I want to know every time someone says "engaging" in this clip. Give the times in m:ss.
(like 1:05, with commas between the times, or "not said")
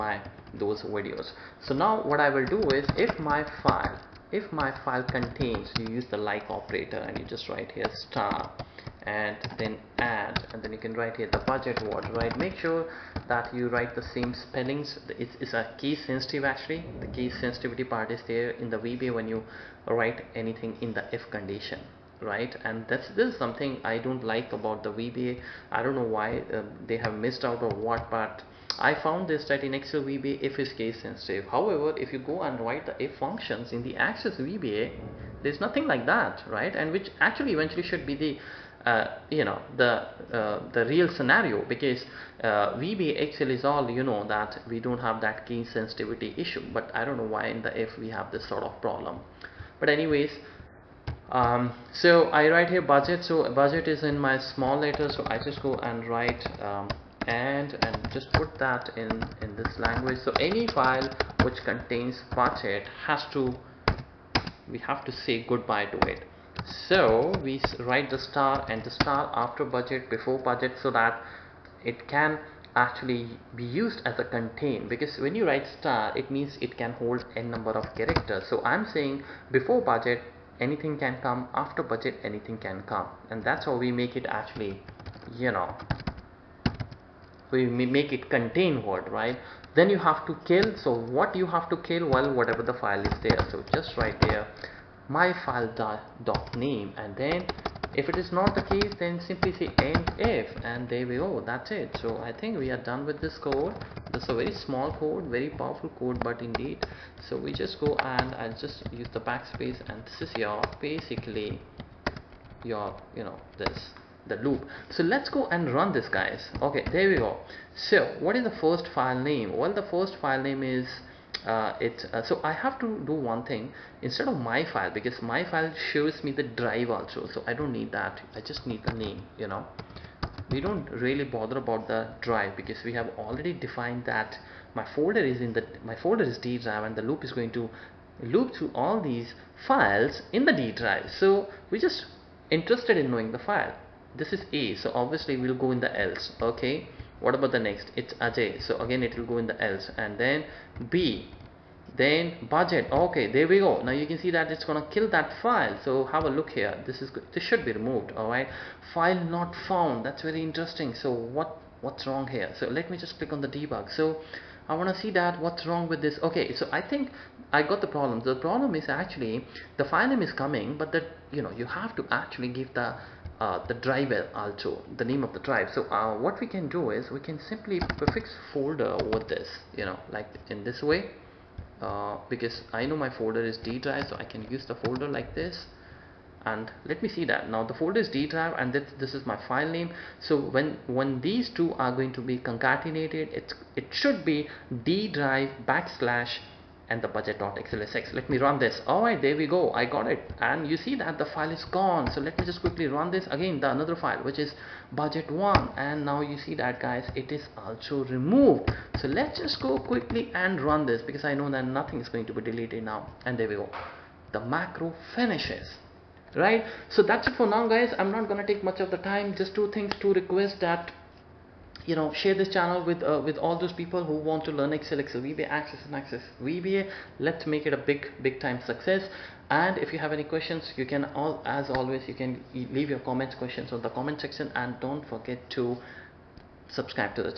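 not said.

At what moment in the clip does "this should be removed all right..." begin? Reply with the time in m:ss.
2:37.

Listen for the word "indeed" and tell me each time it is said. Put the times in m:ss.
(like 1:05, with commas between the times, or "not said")
1:46.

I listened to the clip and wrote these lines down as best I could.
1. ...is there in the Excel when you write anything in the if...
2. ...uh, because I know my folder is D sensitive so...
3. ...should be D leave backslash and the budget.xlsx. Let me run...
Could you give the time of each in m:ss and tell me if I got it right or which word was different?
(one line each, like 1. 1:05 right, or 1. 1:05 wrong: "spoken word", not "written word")
1. 0:18 wrong: "VBA", not "Excel"
2. 3:01 wrong: "drive", not "sensitive"
3. 3:13 wrong: "drive", not "leave".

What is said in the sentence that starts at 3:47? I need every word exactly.
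Let's make it a big, big time success.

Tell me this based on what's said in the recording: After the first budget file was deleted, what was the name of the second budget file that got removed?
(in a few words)
budget1.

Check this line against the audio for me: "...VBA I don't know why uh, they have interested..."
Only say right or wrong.
wrong.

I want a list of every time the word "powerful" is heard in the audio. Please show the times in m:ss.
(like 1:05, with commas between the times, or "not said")
1:45.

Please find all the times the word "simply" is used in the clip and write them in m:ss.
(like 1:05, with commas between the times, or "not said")
1:39, 2:57.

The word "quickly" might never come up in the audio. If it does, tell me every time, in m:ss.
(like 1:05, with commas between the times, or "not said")
3:22, 3:29.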